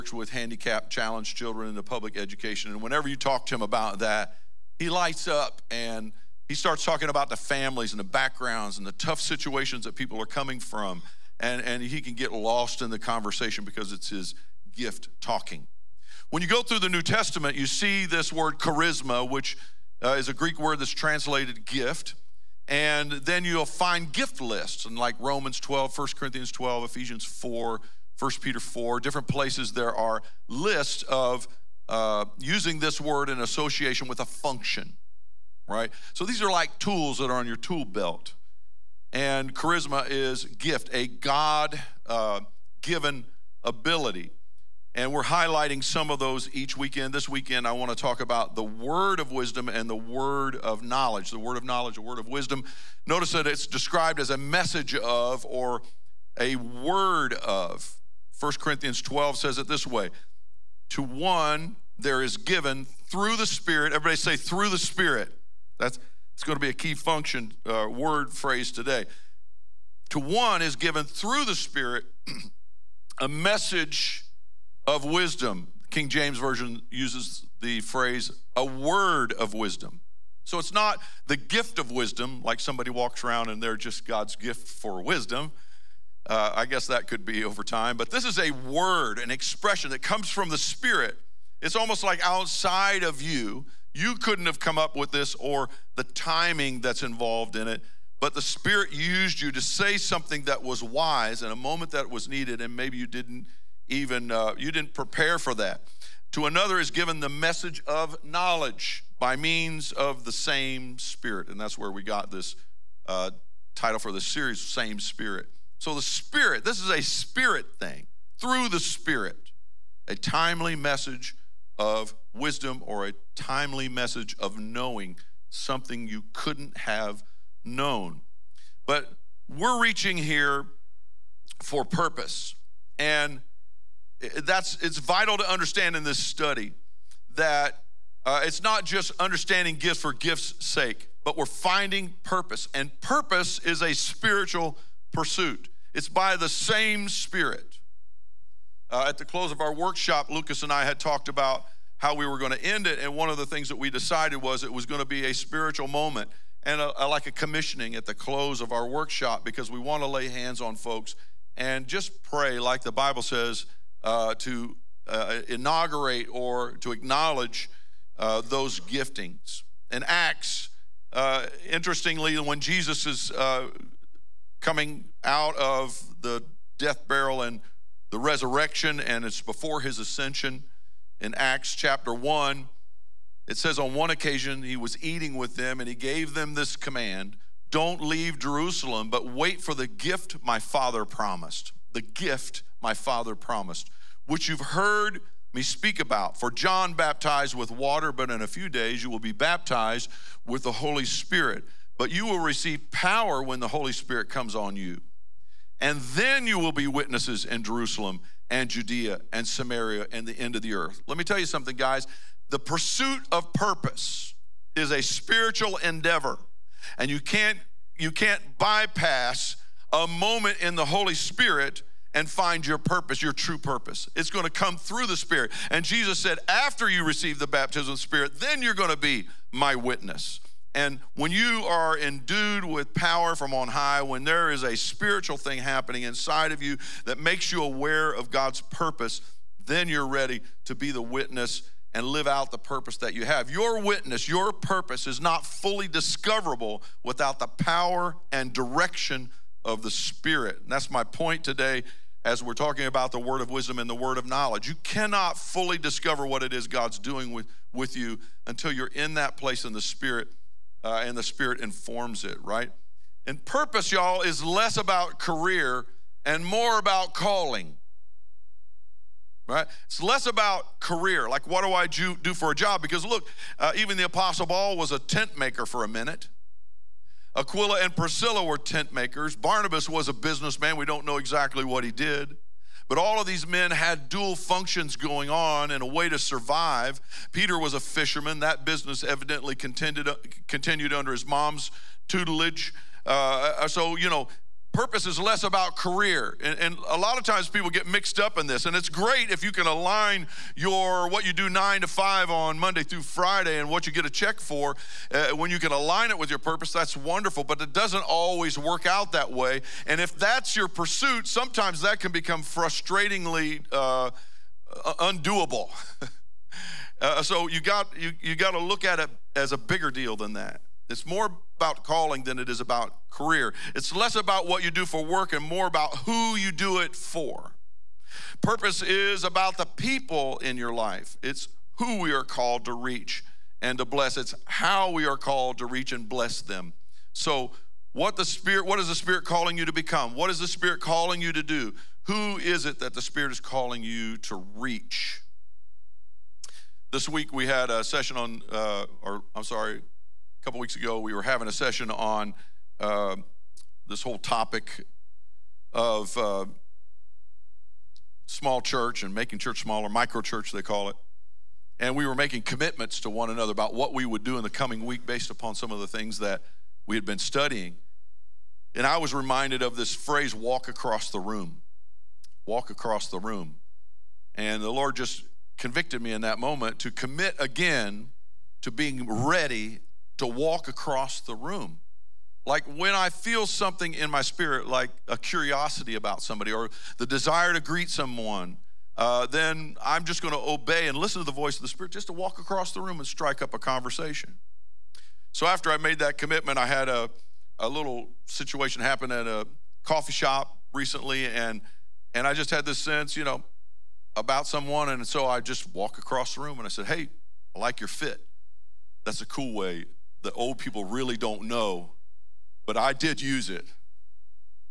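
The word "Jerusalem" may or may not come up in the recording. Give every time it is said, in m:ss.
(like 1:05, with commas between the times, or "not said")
3:08, 3:27.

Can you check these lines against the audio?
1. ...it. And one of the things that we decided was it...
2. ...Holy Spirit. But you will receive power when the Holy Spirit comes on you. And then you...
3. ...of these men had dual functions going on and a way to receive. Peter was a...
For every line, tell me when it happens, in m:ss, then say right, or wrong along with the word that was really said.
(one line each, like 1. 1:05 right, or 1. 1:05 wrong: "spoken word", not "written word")
1. 2:32 right
2. 3:20 right
3. 4:43 wrong: "survive", not "receive".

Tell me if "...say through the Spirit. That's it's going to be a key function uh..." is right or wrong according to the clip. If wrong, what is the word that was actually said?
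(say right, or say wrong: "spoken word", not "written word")
right.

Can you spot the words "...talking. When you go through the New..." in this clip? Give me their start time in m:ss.
0:15.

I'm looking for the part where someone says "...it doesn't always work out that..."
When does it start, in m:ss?
5:07.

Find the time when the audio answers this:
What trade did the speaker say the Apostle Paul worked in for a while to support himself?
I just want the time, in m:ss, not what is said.
4:34.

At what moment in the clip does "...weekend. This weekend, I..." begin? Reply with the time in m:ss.
0:46.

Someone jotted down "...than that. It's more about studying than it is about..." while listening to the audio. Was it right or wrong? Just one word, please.
wrong.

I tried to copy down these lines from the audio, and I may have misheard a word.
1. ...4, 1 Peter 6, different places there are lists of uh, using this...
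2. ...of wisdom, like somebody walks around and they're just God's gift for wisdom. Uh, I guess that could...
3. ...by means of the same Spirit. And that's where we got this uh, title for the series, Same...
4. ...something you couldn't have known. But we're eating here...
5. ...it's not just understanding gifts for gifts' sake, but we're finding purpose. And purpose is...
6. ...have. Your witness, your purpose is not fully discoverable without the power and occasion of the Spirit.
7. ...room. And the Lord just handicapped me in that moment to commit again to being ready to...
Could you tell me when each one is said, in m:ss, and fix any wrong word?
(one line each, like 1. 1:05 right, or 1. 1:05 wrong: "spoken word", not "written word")
1. 0:27 wrong: "4", not "6"
2. 1:21 right
3. 1:49 right
4. 2:05 wrong: "reaching", not "eating"
5. 2:18 right
6. 4:03 wrong: "direction", not "occasion"
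7. 6:13 wrong: "convicted", not "handicapped".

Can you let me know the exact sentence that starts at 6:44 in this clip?
And so I just walk across the room and I said, Hey, I like your fit.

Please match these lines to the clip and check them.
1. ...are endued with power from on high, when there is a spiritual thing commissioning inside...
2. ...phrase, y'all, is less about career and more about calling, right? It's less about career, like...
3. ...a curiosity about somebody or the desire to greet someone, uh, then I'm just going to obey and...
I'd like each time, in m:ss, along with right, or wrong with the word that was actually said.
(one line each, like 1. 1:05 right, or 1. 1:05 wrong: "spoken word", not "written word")
1. 3:51 wrong: "happening", not "commissioning"
2. 4:23 wrong: "purpose", not "phrase"
3. 6:25 right.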